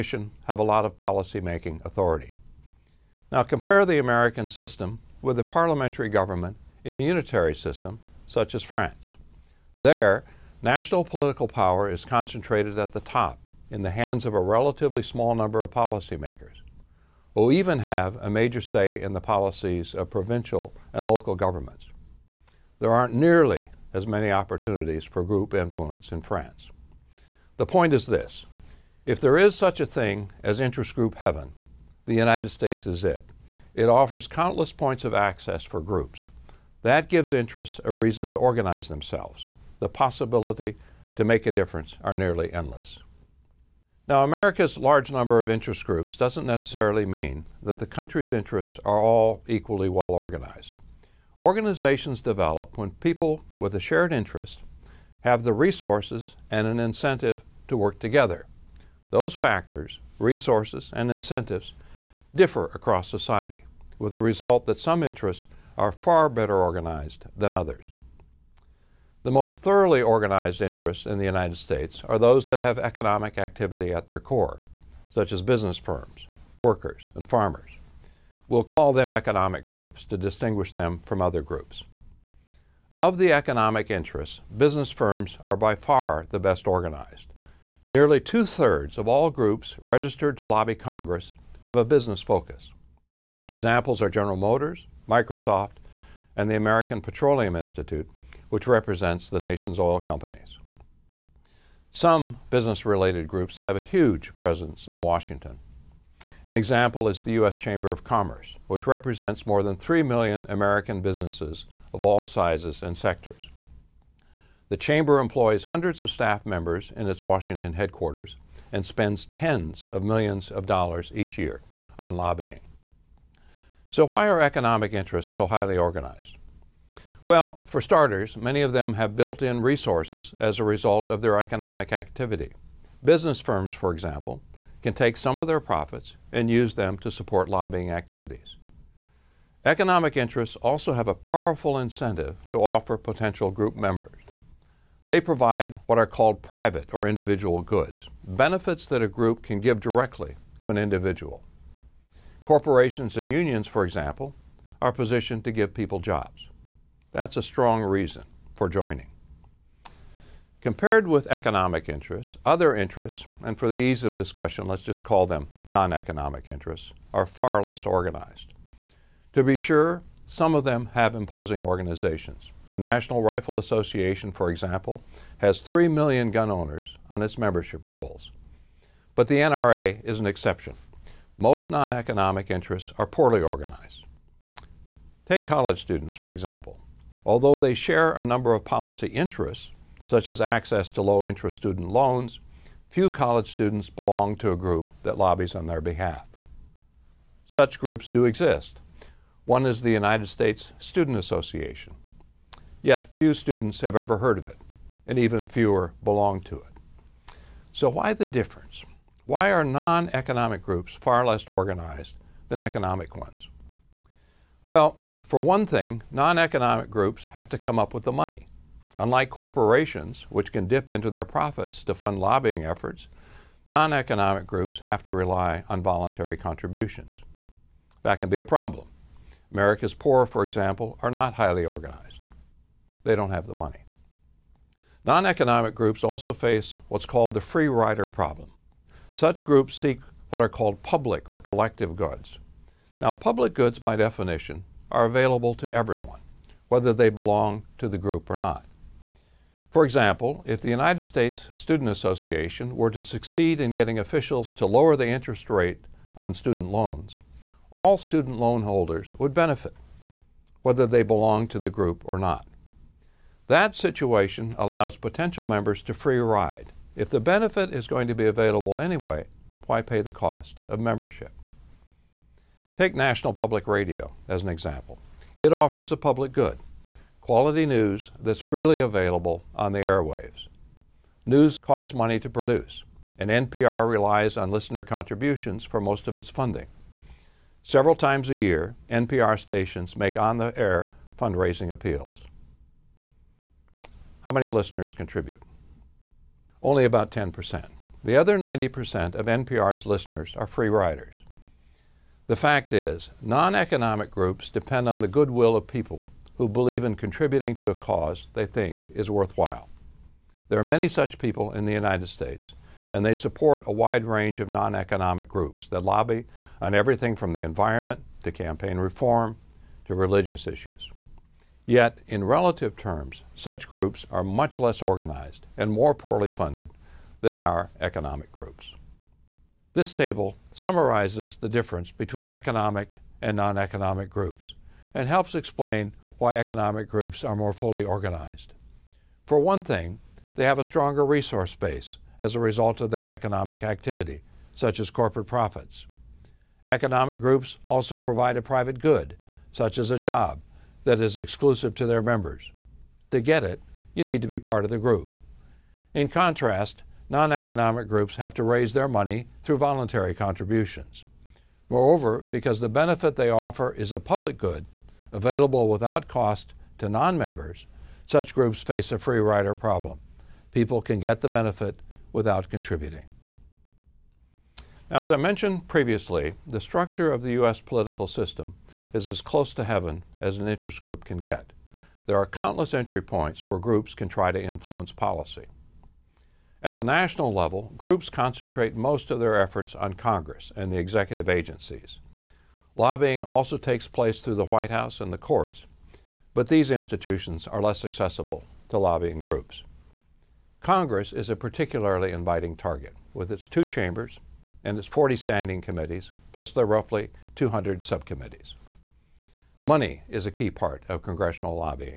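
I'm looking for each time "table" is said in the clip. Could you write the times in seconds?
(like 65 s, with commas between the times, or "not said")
329 s.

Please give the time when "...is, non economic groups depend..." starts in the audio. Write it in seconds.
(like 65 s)
302 s.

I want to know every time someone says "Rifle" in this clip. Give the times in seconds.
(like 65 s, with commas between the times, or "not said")
173 s.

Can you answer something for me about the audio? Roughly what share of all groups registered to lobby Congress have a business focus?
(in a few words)
2/3.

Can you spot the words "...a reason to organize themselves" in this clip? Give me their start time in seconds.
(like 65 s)
37 s.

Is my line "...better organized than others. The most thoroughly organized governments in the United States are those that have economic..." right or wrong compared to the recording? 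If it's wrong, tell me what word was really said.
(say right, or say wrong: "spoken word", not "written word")
wrong: "interests", not "governments".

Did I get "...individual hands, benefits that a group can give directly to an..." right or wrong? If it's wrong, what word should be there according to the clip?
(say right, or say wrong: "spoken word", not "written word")
wrong: "goods", not "hands".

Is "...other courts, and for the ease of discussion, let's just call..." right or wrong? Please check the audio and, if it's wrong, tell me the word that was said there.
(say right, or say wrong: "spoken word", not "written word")
wrong: "interests", not "courts".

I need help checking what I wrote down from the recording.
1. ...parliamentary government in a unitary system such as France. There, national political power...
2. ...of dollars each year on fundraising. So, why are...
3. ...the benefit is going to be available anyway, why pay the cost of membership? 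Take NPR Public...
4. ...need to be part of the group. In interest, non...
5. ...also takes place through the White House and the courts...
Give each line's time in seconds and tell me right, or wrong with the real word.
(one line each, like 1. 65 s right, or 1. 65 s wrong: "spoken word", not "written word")
1. 5 s right
2. 120 s wrong: "lobbying", not "fundraising"
3. 267 s wrong: "National", not "NPR"
4. 354 s wrong: "contrast", not "interest"
5. 393 s right.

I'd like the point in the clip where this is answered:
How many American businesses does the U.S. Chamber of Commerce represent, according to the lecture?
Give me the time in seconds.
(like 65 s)
109 s.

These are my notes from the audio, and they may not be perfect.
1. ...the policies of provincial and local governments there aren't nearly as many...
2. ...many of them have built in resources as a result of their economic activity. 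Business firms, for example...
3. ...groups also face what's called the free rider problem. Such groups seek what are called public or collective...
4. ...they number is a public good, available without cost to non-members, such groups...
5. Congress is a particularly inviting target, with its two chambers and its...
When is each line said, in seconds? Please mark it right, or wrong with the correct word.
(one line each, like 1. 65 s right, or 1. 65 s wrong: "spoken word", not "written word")
1. 19 s right
2. 128 s right
3. 235 s right
4. 363 s wrong: "offer", not "number"
5. 400 s right.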